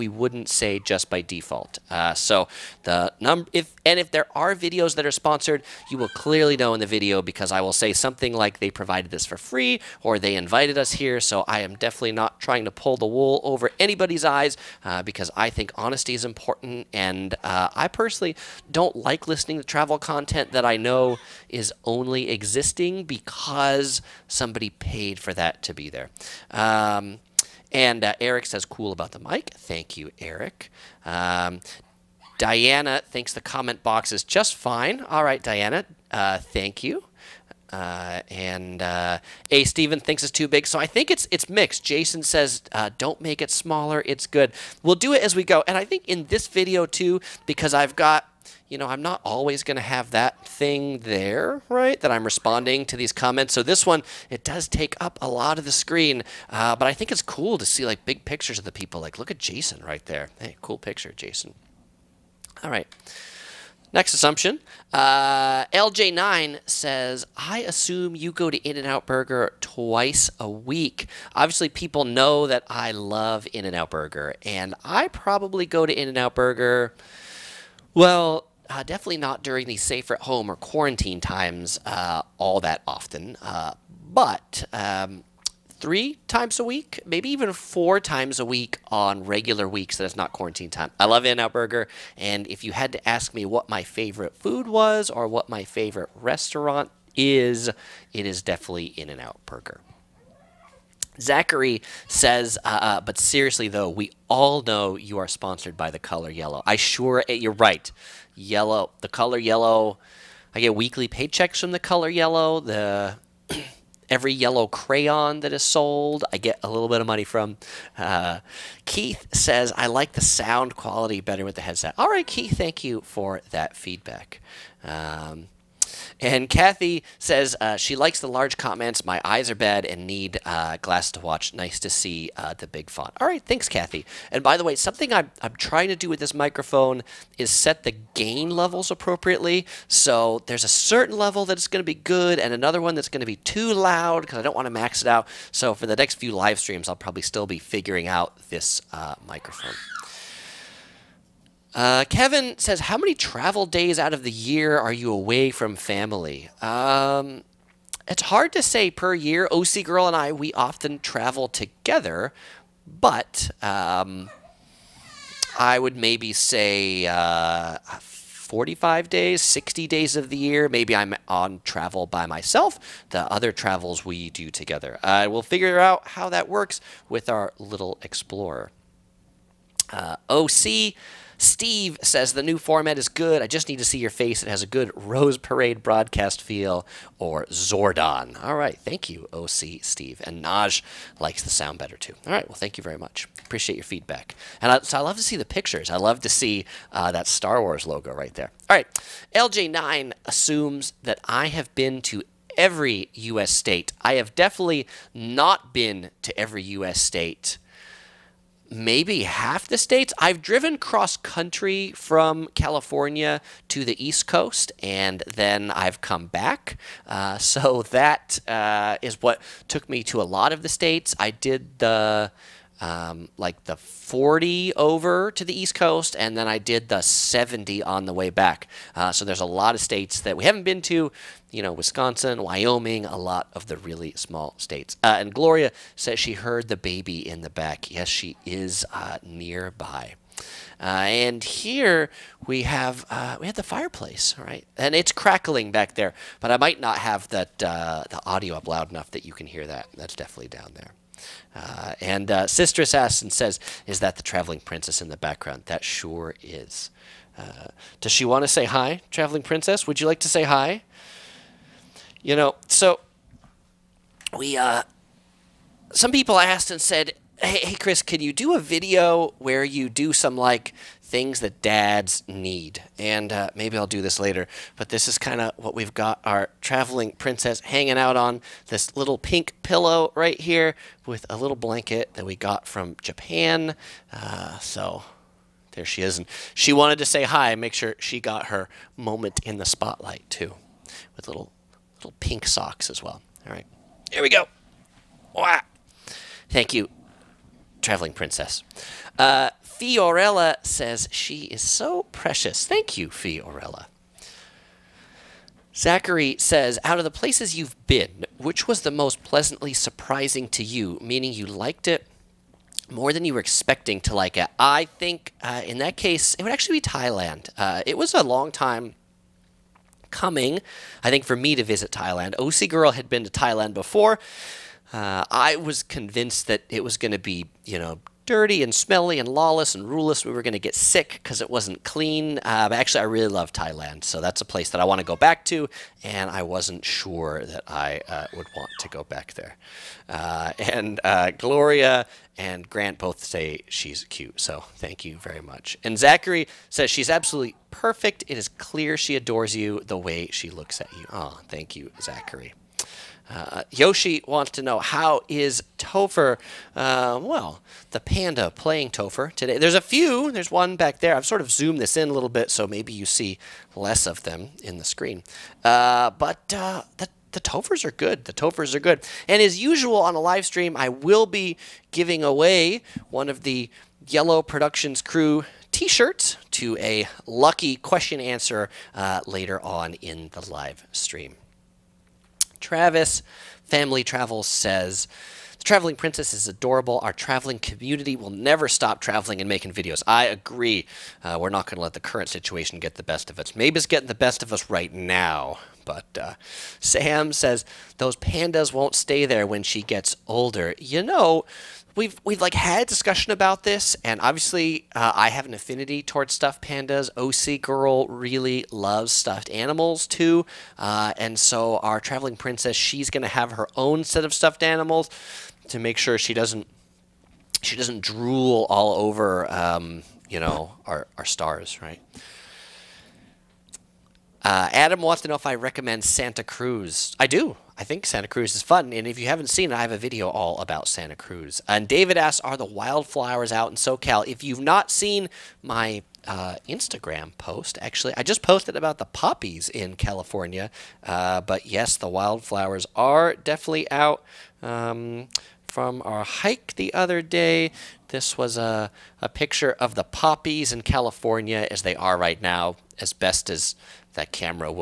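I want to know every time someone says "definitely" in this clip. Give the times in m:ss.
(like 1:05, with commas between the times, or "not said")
0:11, 1:18, 1:38, 3:24, 4:10, 7:23.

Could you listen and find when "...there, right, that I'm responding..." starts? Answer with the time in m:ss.
0:50.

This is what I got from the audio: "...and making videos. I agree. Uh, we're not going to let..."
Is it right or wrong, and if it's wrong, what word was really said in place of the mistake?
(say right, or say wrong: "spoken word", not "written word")
right.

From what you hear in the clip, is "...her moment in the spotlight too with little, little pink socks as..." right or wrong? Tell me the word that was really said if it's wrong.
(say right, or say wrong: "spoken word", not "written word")
right.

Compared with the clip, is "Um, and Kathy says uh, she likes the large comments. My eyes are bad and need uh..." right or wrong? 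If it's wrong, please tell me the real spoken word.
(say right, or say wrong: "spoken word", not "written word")
right.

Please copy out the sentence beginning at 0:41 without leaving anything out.
Jason says, uh, "Don't make it smaller.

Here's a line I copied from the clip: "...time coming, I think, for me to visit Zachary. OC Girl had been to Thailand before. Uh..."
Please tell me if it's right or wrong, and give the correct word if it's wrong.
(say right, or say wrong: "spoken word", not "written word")
wrong: "Thailand", not "Zachary".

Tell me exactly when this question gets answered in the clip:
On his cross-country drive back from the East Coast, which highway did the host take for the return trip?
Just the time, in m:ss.
3:46.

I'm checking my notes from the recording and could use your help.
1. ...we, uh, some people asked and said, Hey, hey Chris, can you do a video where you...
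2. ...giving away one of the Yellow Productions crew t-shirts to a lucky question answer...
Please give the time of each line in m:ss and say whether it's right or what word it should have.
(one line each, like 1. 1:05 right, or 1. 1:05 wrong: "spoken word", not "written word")
1. 4:24 right
2. 6:11 right.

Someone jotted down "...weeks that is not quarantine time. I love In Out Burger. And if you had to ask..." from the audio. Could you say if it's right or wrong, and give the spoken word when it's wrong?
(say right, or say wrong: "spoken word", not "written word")
right.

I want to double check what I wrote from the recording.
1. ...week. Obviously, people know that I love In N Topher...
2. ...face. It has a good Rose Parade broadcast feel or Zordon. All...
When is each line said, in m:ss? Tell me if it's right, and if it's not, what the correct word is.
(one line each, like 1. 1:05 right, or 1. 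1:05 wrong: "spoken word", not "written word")
1. 1:10 wrong: "Out", not "Topher"
2. 3:04 right.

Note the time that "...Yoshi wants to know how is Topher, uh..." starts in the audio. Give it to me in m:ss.
5:53.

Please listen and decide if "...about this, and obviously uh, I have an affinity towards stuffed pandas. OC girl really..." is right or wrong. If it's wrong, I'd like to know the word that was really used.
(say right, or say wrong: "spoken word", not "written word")
right.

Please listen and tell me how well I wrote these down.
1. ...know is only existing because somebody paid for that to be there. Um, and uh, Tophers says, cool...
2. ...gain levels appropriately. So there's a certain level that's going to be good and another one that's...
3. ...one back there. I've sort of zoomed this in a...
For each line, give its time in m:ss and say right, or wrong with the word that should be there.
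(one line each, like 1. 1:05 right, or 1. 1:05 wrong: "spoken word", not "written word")
1. 0:20 wrong: "Eric", not "Tophers"
2. 2:18 right
3. 6:00 right.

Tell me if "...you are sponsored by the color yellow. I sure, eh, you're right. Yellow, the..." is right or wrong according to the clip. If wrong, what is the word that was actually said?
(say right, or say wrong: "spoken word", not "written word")
right.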